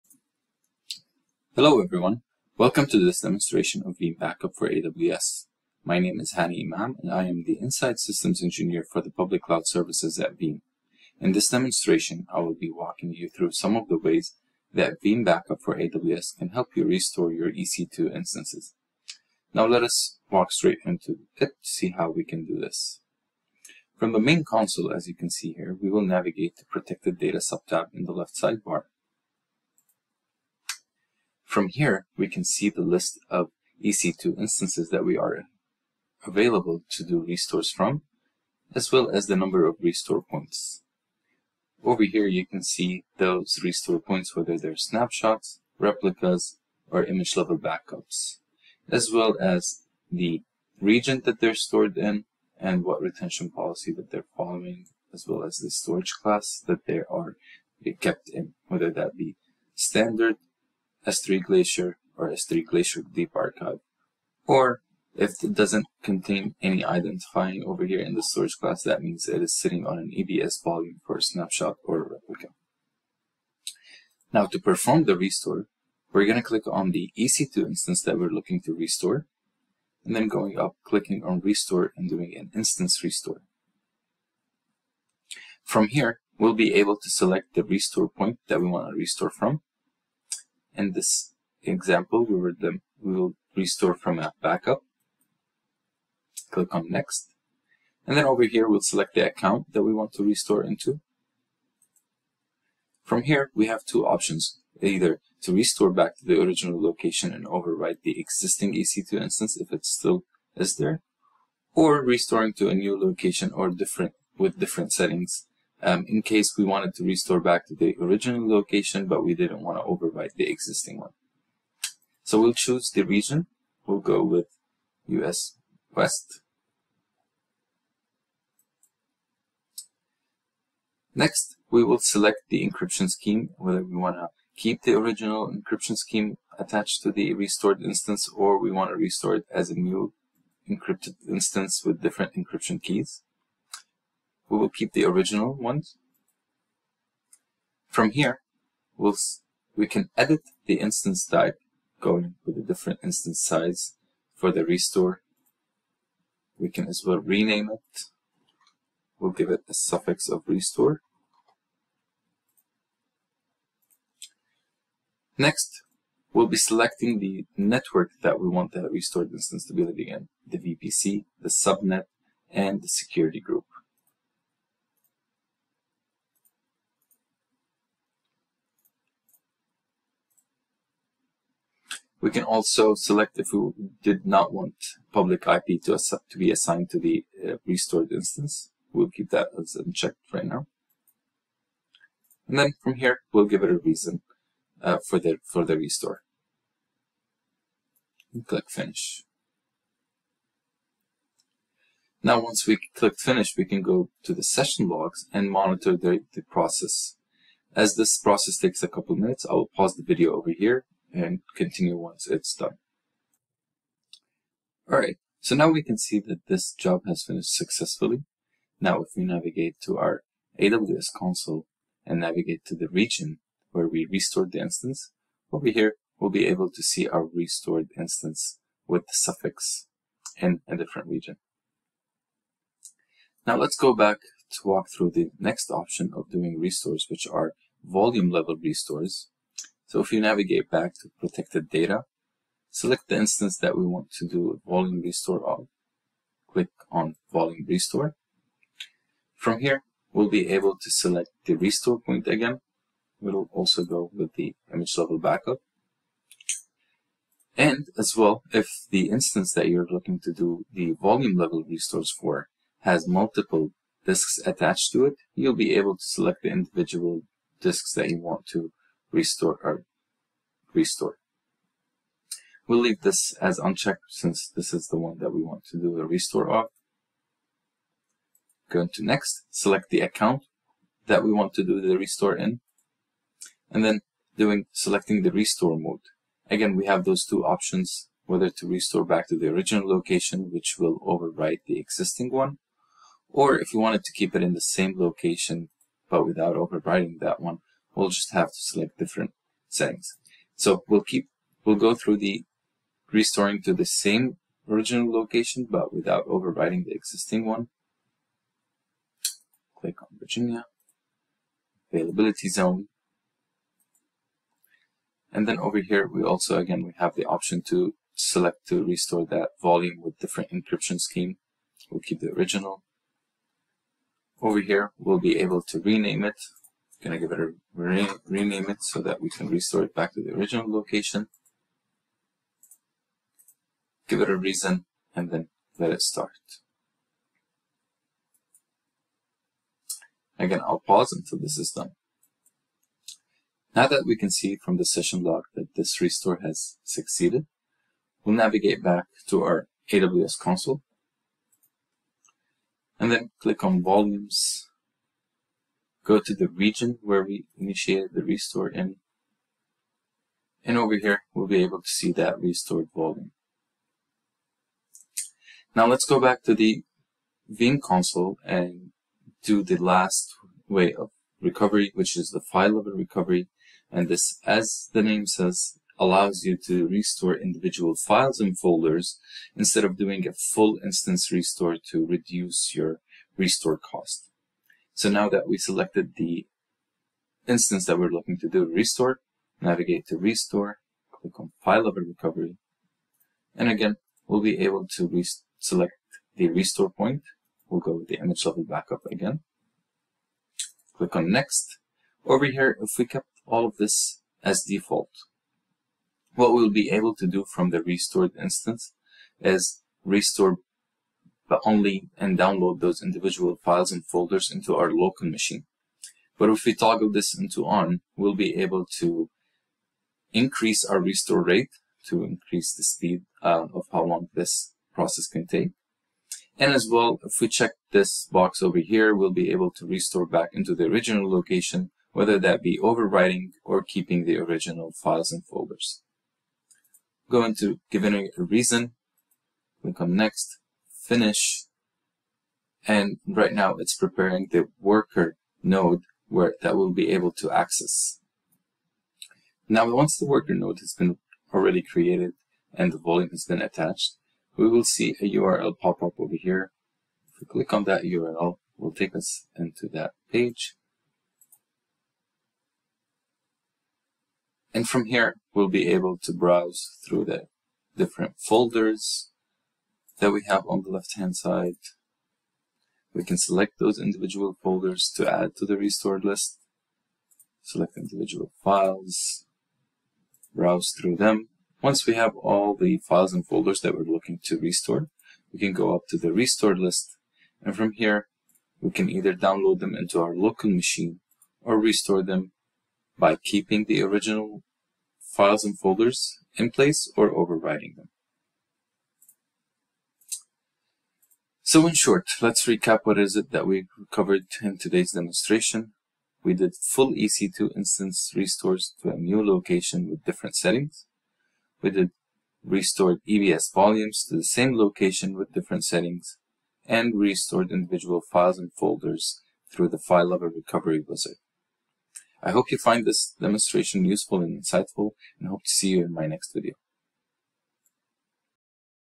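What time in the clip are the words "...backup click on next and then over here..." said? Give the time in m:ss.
1:34.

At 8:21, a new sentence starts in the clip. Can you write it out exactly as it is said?
So in short, let's recap what is it that we covered in today's demonstration.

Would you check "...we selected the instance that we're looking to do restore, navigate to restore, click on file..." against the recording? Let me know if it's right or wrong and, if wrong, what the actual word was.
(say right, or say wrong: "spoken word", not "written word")
right.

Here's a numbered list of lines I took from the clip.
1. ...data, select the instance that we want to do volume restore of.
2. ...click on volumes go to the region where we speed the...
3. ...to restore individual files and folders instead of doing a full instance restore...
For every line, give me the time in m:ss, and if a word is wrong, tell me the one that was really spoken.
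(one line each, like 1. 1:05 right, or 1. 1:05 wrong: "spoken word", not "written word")
1. 4:01 right
2. 5:53 wrong: "initiated", not "speed"
3. 6:16 right.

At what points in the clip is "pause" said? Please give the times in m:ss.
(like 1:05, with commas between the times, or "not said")
3:29, 5:40.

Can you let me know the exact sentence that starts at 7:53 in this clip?
We can select those individual folders to add to the restored list, select individual files, browse through them.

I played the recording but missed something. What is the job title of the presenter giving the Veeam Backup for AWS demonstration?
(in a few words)
Inside Systems Engineer.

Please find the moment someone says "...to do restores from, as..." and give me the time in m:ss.
0:36.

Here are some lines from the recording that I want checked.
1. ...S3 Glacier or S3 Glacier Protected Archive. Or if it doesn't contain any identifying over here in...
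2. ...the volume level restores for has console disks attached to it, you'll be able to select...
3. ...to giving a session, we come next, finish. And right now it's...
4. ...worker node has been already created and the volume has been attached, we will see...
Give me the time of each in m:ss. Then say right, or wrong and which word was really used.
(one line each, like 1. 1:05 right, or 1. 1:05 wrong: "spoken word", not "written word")
1. 1:01 wrong: "Deep", not "Protected"
2. 4:20 wrong: "multiple", not "console"
3. 7:17 wrong: "reason", not "session"
4. 7:30 right.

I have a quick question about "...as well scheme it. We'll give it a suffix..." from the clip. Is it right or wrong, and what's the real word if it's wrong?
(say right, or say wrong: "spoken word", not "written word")
wrong: "rename", not "scheme".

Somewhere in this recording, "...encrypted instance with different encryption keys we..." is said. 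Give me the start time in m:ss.
2:20.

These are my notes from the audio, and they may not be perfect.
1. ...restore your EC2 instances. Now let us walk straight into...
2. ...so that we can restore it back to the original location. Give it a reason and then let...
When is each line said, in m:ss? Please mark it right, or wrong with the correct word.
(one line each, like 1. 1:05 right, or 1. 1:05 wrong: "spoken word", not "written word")
1. 0:16 right
2. 5:28 right.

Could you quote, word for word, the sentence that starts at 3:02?
We can also select if we did not want public IP to, to be assigned to the uh, restored instance.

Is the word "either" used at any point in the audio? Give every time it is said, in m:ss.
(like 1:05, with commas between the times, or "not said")
1:44, 8:09.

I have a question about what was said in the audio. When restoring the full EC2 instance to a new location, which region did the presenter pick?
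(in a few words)
US West.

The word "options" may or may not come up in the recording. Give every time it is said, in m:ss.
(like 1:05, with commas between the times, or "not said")
1:44, 3:55, 4:47, 5:17.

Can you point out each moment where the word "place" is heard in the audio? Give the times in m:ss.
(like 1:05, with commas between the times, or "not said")
8:16.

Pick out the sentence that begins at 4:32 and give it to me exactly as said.
We'll leave this as unchecked since this is the one that we want to do a restore of.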